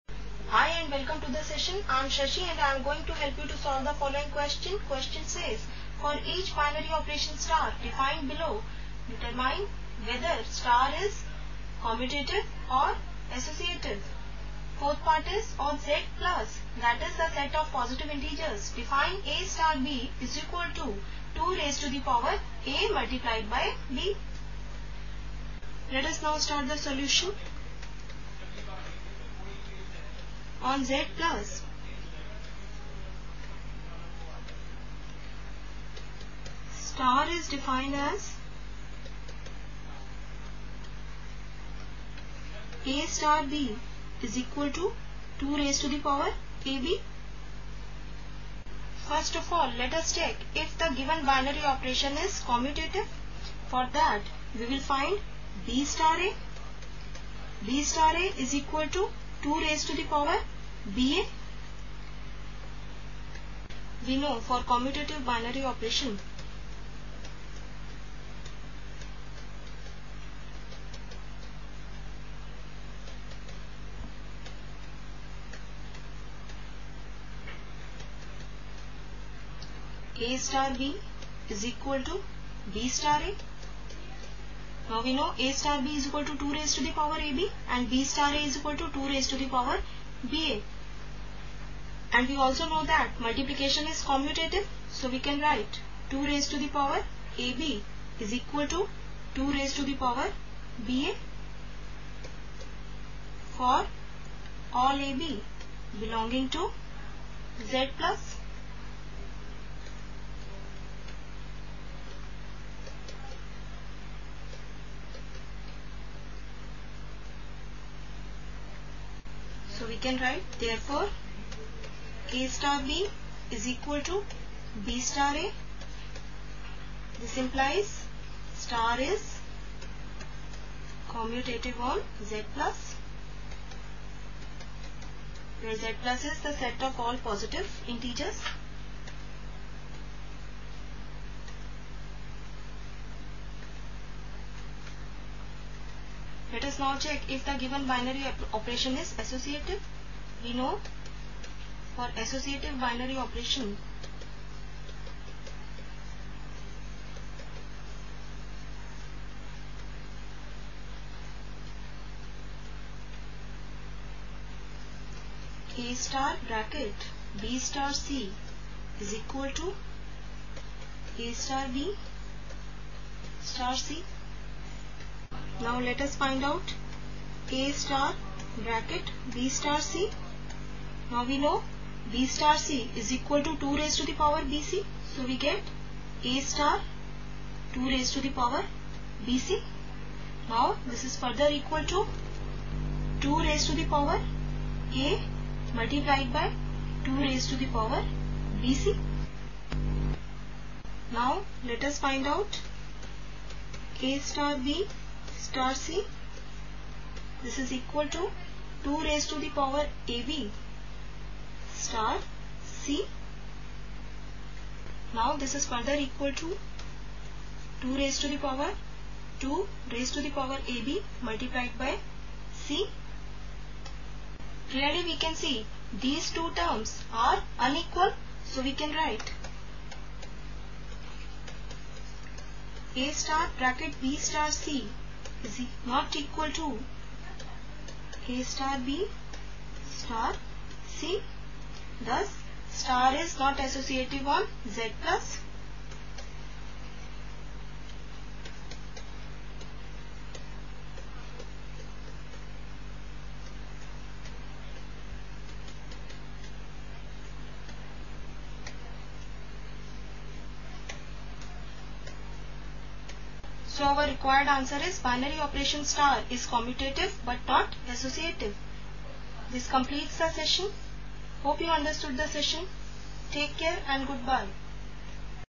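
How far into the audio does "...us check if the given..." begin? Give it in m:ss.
0:49.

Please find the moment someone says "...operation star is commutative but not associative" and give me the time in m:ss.
4:25.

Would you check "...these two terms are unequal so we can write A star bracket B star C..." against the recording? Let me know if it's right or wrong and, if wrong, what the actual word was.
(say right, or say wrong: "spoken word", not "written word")
right.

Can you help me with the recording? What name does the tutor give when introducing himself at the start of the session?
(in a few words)
Shashi.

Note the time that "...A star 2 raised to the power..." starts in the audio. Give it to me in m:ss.
3:06.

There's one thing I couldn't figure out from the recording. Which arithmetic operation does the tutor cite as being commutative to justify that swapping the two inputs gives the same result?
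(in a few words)
multiplication.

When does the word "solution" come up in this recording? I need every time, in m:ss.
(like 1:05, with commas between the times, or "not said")
0:26.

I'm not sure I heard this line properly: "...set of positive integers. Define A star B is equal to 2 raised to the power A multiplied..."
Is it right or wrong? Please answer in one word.
right.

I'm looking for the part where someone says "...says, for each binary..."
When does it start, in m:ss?
0:05.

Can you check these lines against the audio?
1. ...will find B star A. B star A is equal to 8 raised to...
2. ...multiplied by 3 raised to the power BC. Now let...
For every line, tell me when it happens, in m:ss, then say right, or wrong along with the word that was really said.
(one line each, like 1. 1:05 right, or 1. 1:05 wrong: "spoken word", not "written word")
1. 0:54 wrong: "2", not "8"
2. 3:15 wrong: "2", not "3".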